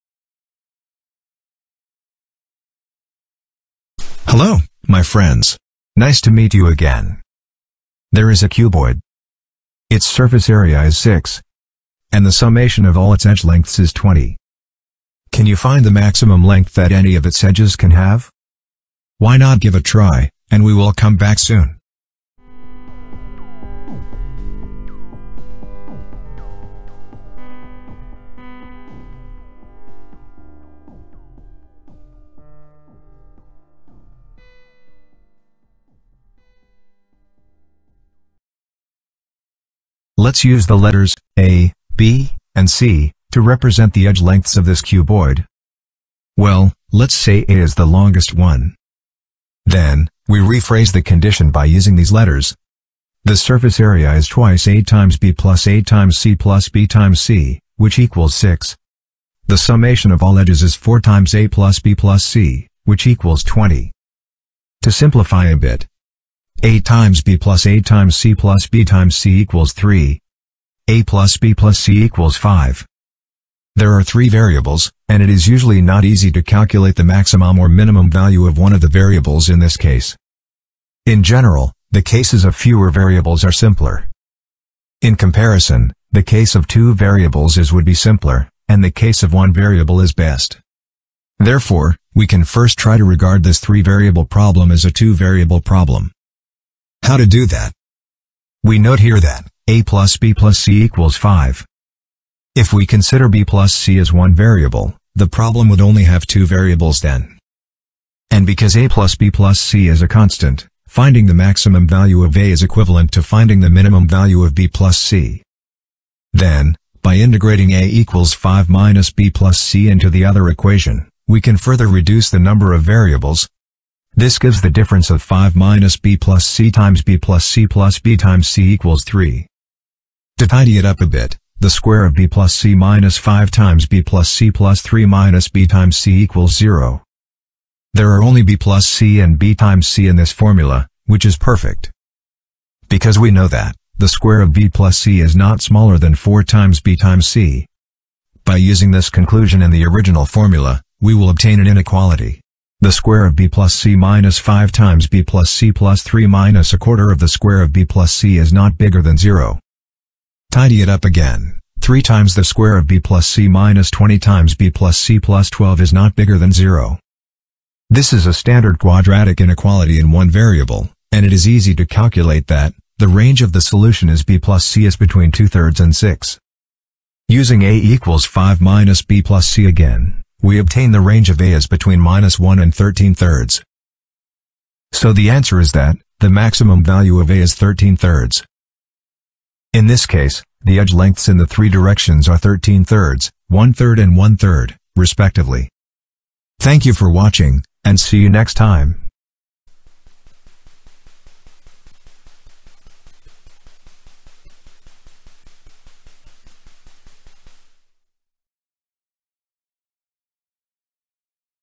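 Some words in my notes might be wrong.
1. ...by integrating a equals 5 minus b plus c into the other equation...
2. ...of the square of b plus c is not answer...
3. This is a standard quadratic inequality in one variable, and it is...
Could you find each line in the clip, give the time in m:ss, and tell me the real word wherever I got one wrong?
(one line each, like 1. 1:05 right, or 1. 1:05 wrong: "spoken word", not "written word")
1. 1:57 right
2. 2:37 wrong: "bigger", not "answer"
3. 2:47 right.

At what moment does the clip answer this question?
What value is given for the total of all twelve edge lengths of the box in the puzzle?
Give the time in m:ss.
0:12.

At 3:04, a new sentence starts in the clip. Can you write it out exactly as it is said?
So the answer is that, the maximum value of A is 13 thirds.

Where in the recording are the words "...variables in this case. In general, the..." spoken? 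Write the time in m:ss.
1:18.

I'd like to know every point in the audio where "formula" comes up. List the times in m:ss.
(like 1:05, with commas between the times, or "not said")
2:20, 2:30.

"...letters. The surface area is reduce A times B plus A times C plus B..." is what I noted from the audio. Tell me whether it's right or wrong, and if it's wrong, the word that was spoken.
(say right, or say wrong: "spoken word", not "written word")
wrong: "twice", not "reduce".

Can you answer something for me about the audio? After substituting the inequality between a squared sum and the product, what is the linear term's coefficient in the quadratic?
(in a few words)
20.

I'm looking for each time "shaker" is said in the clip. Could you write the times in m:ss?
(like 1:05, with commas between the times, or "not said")
not said.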